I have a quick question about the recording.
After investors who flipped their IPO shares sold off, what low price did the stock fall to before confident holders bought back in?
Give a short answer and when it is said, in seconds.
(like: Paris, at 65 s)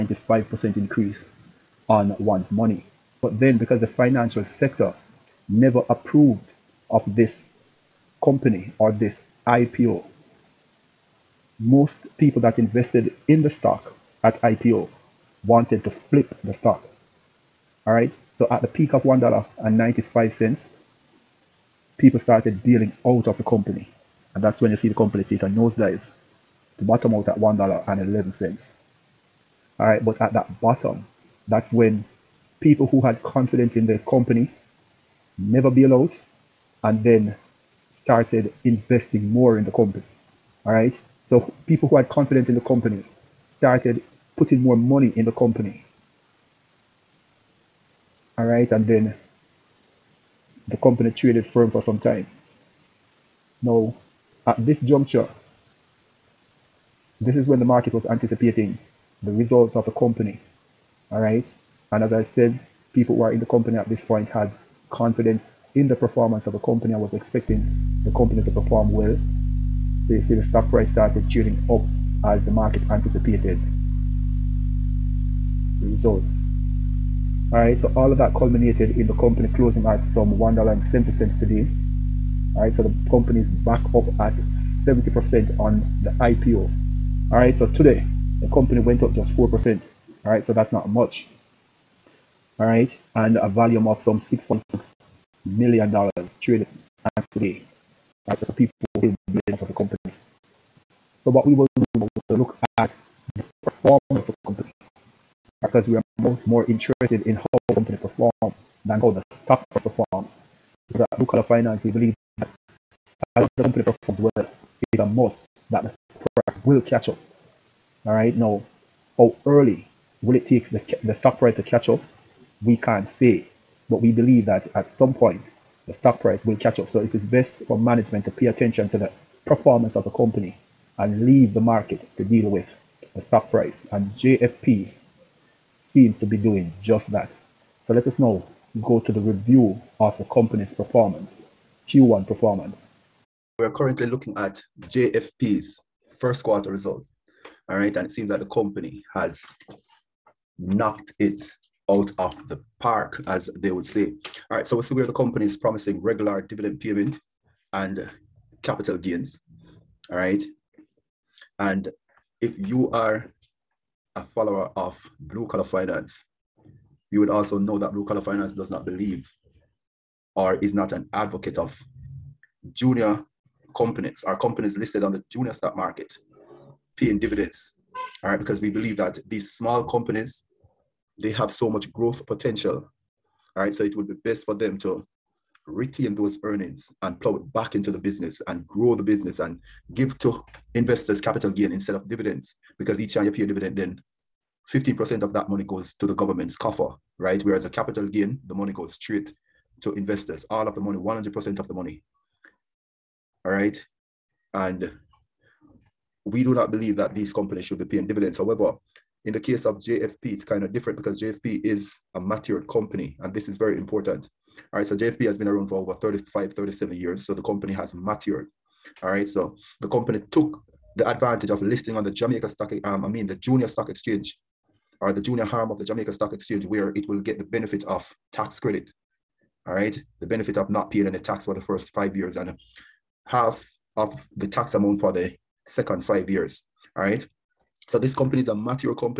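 $1.11, at 27 s.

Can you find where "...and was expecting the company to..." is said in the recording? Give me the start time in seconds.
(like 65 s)
66 s.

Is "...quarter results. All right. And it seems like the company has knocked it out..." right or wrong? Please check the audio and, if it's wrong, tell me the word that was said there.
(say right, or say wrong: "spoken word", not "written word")
right.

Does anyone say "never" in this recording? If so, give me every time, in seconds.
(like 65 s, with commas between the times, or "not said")
5 s, 35 s.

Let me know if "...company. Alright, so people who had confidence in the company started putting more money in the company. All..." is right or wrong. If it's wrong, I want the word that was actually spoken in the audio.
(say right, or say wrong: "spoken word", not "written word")
right.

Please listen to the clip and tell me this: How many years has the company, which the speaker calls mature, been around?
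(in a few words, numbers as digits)
37 years.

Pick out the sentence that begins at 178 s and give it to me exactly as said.
All right, because we believe that these small companies, they have so much growth potential.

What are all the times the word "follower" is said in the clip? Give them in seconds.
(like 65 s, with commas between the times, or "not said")
164 s.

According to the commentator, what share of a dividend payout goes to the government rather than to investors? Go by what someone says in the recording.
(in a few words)
15%.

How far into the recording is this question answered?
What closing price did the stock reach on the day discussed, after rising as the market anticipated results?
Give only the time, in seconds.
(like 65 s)
80 s.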